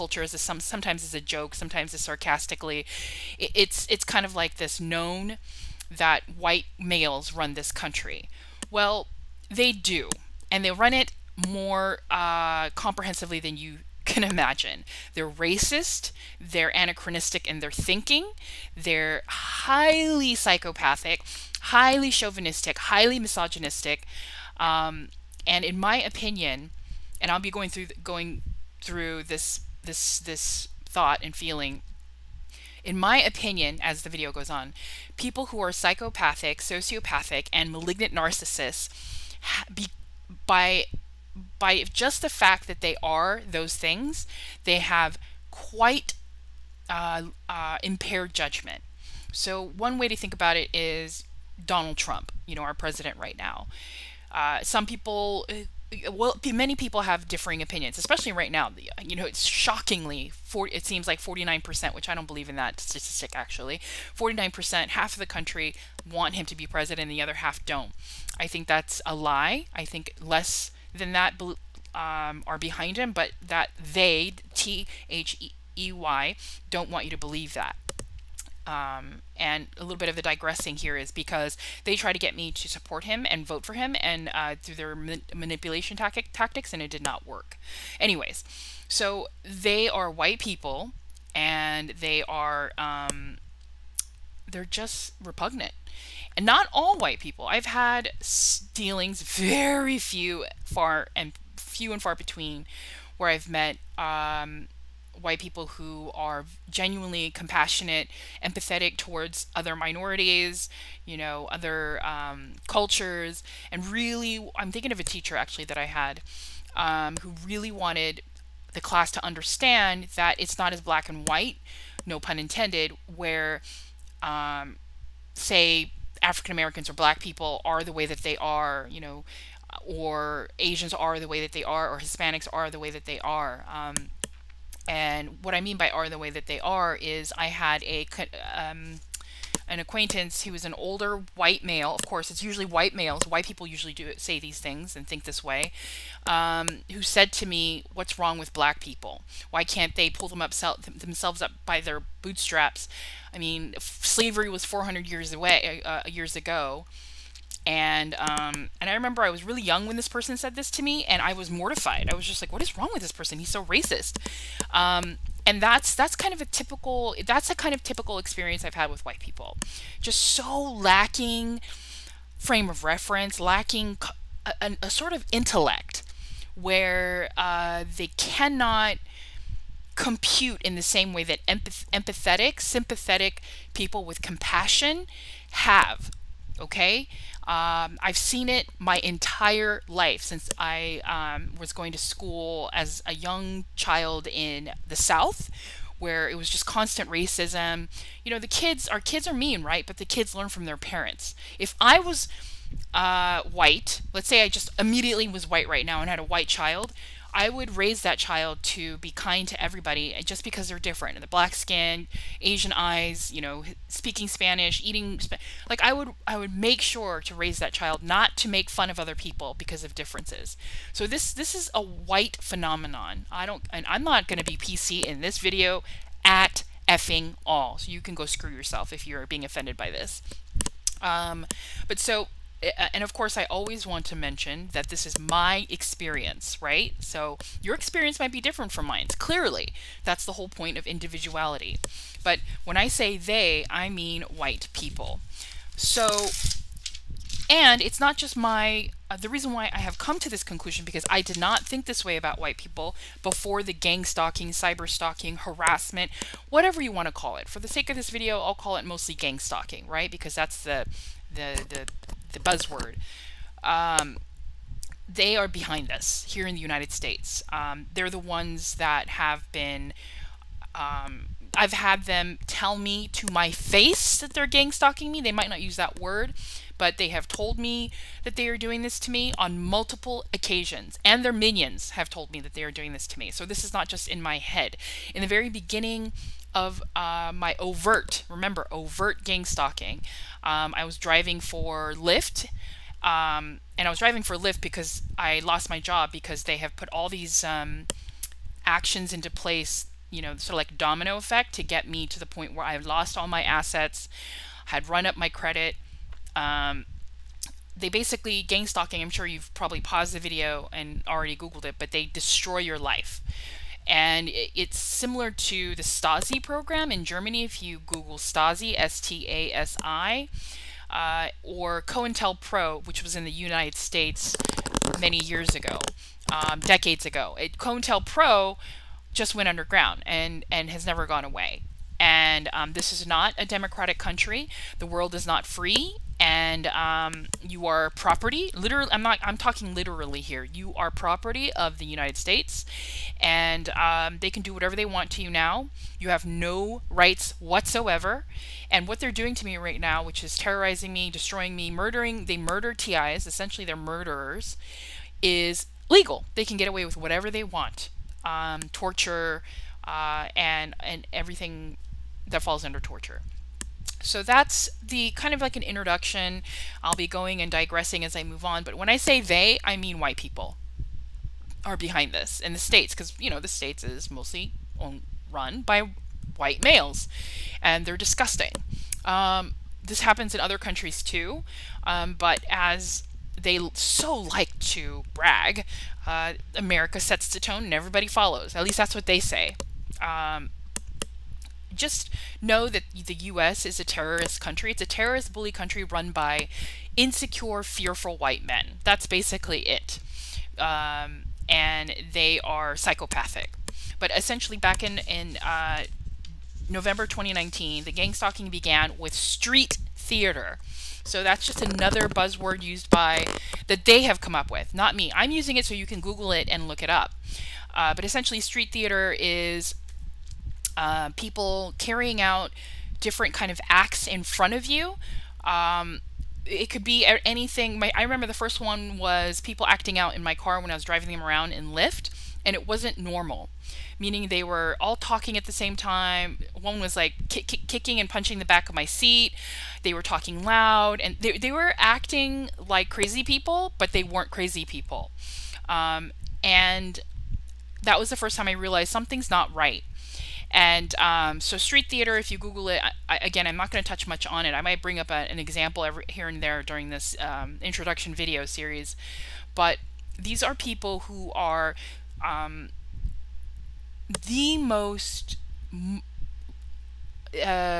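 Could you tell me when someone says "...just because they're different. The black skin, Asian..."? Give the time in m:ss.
3:30.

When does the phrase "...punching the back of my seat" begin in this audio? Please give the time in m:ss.
7:18.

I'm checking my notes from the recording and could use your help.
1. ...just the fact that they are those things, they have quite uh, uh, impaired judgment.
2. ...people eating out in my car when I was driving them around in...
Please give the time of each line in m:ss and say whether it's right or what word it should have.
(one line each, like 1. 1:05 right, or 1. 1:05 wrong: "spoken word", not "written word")
1. 0:41 right
2. 7:09 wrong: "acting", not "eating".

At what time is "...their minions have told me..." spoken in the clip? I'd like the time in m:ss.
4:41.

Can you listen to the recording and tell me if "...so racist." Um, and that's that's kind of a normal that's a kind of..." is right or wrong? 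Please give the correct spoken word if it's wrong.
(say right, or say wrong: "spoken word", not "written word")
wrong: "typical", not "normal".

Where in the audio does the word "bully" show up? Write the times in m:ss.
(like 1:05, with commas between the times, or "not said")
6:35.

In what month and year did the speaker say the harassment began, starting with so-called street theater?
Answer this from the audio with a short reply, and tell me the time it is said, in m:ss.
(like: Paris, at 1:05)
November 2019, at 6:46.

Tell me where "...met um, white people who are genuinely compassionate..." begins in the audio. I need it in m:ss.
1:43.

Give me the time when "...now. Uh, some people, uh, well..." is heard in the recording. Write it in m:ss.
0:53.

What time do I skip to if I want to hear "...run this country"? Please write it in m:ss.
0:07.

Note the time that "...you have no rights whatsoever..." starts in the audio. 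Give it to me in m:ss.
5:45.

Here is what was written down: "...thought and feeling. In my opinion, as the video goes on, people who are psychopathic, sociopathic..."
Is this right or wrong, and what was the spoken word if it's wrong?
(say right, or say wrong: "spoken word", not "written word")
right.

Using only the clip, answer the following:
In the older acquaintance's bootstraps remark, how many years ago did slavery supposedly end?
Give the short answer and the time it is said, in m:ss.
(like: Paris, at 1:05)
400, at 2:34.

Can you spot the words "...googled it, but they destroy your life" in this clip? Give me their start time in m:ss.
5:11.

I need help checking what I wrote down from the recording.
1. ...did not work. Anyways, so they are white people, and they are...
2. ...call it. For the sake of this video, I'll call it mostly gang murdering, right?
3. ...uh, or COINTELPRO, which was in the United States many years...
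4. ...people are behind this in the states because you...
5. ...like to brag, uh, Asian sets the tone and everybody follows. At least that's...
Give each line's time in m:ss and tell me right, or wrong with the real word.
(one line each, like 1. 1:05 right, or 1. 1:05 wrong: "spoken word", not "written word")
1. 1:26 right
2. 4:17 wrong: "stalking", not "murdering"
3. 5:20 right
4. 6:10 right
5. 6:24 wrong: "America", not "Asian".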